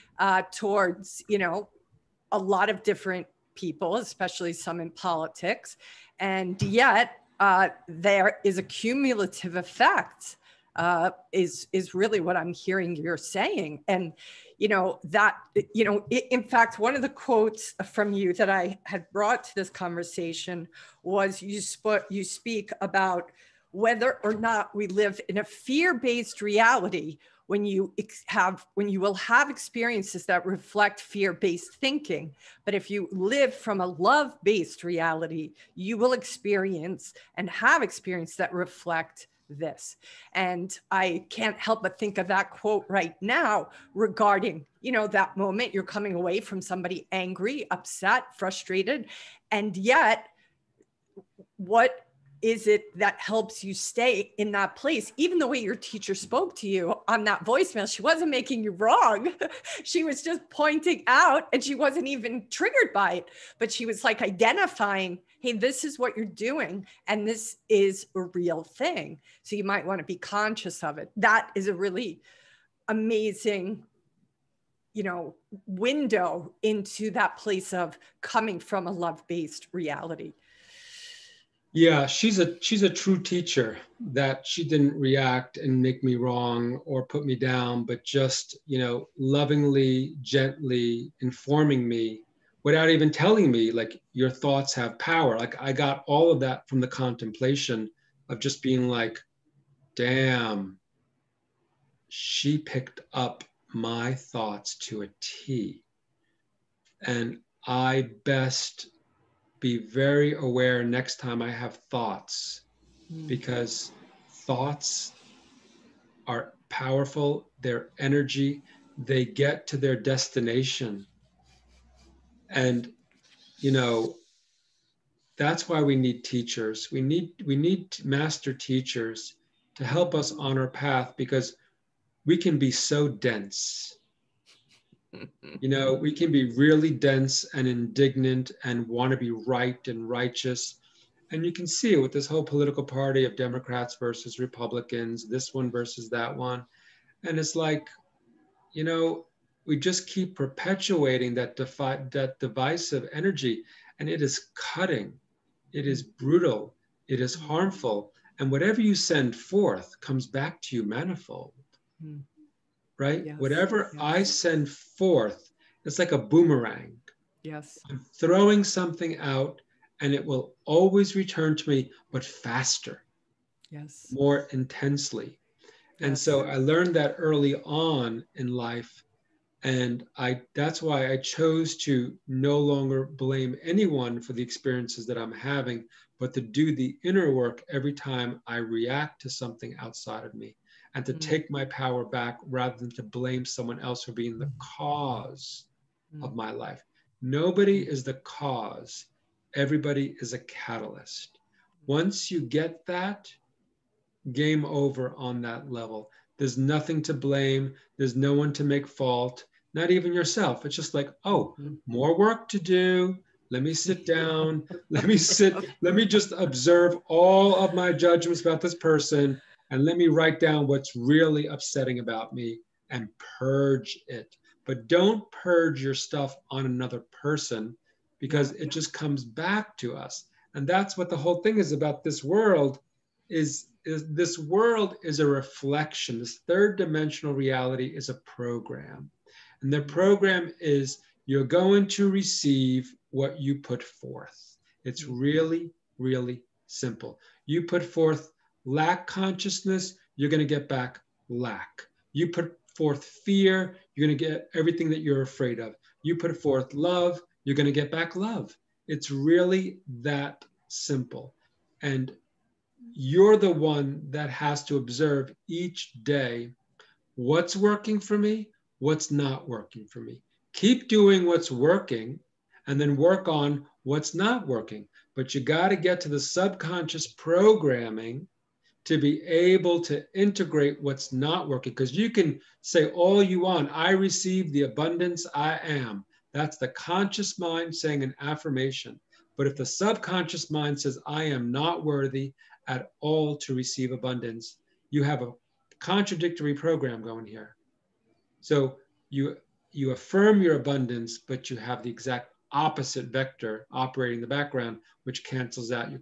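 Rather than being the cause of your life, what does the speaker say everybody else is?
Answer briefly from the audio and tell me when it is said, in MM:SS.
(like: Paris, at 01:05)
a catalyst, at 03:20.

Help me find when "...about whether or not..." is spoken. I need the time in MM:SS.
00:22.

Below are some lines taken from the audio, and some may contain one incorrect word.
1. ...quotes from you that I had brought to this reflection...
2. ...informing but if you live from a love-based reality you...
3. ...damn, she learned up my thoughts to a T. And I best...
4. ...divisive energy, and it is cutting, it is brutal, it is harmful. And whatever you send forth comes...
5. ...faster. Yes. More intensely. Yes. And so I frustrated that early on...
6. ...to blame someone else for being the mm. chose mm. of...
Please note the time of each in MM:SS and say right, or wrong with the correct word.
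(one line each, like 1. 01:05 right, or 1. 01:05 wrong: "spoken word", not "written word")
1. 00:17 wrong: "conversation", not "reflection"
2. 00:31 wrong: "thinking", not "informing"
3. 01:39 wrong: "picked", not "learned"
4. 02:32 right
5. 02:52 wrong: "learned", not "frustrated"
6. 03:12 wrong: "cause", not "chose".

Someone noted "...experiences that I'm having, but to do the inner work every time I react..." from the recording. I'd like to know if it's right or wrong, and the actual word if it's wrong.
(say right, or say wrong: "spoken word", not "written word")
right.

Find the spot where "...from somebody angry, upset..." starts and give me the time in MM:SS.
00:46.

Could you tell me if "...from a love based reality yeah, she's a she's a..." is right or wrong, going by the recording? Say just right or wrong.
right.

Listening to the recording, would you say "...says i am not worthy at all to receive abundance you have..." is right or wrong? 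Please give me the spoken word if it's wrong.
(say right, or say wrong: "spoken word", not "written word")
right.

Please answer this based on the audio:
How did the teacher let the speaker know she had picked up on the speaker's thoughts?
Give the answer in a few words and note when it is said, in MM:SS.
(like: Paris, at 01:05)
voicemail, at 00:57.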